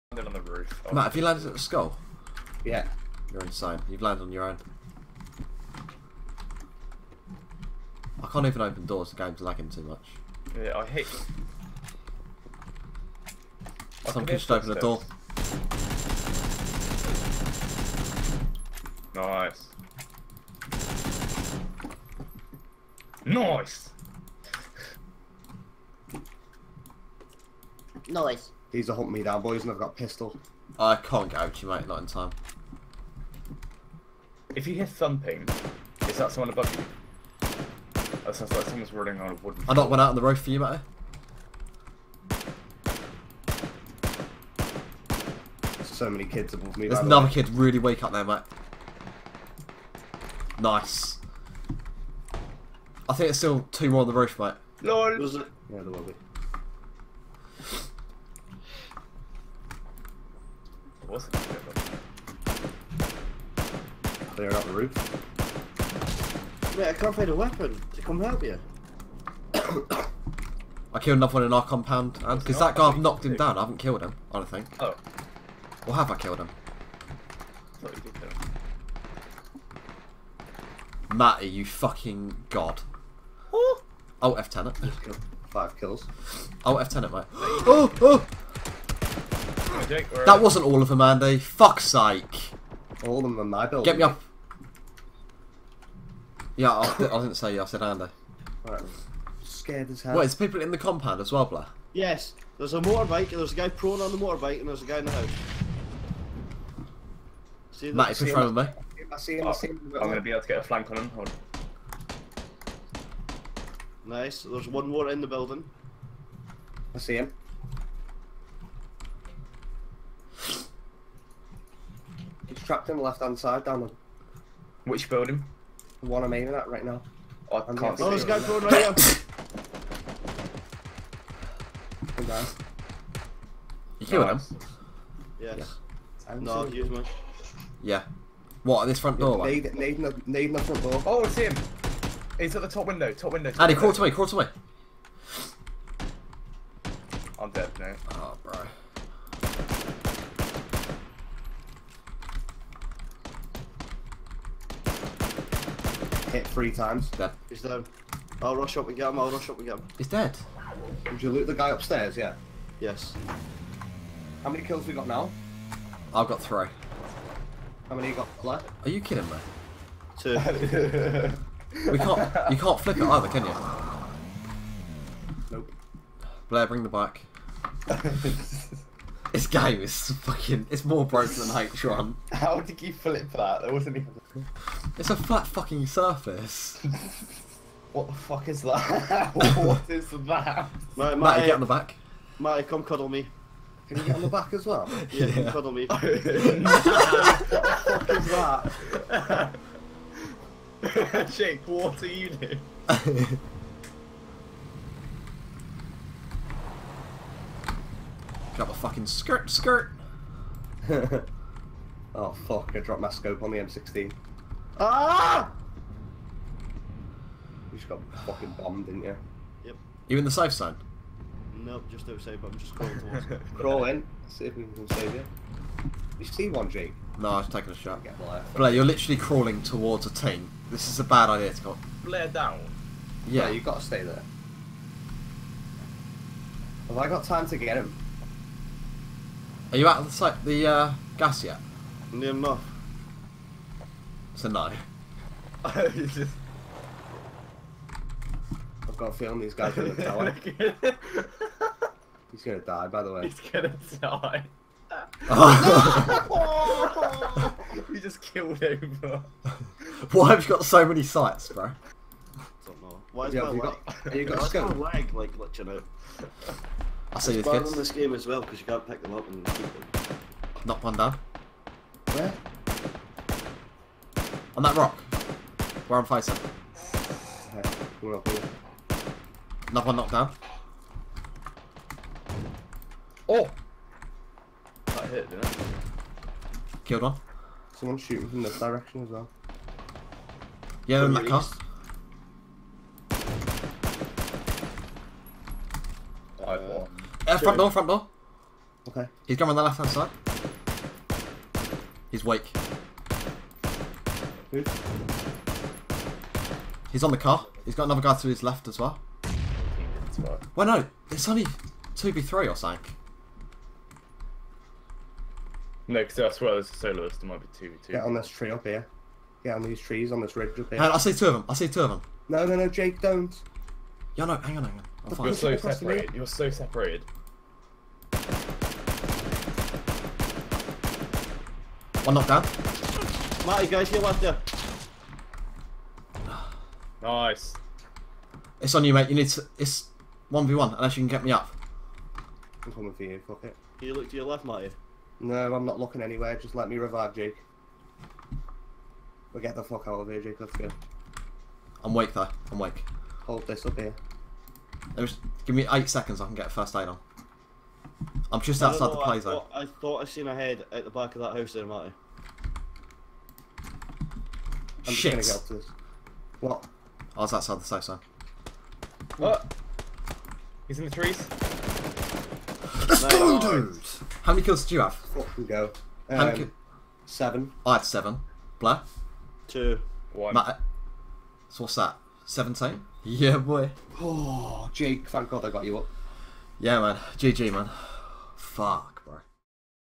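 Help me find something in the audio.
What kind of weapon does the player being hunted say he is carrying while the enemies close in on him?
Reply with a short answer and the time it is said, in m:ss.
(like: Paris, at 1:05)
pistol, at 0:29.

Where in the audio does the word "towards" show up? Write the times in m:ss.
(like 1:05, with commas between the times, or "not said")
3:42, 3:49.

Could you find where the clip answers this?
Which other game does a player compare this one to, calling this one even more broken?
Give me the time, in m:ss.
3:01.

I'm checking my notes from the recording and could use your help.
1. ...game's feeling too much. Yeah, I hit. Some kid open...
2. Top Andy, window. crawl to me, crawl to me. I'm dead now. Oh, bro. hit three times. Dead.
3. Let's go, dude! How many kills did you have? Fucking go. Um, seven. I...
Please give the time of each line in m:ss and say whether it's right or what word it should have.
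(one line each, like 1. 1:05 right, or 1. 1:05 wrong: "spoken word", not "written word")
1. 0:09 wrong: "lagging", not "feeling"
2. 2:23 right
3. 6:12 right.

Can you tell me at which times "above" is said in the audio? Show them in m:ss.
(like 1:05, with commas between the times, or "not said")
0:36, 0:46.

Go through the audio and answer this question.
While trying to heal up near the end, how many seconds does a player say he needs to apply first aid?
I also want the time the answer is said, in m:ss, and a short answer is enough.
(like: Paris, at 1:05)
8, at 5:55.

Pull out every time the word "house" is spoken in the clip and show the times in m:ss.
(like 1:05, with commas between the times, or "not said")
1:45, 6:01.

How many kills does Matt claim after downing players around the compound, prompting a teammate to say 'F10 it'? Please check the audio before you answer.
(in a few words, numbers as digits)
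5.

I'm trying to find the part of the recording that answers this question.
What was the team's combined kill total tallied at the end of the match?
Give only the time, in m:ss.
6:22.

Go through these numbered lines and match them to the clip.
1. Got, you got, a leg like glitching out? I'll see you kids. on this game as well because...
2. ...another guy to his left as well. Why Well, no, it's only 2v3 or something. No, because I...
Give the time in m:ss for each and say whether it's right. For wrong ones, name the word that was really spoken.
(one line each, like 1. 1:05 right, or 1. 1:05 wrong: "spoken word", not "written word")
1. 4:24 right
2. 5:07 right.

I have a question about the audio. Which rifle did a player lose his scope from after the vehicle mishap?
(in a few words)
M16.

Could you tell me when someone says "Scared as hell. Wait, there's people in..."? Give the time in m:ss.
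1:39.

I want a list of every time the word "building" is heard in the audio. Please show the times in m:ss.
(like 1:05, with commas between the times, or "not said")
1:33, 1:55, 2:05.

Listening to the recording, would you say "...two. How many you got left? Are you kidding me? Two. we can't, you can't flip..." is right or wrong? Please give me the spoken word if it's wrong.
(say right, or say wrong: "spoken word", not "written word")
wrong: "three", not "two".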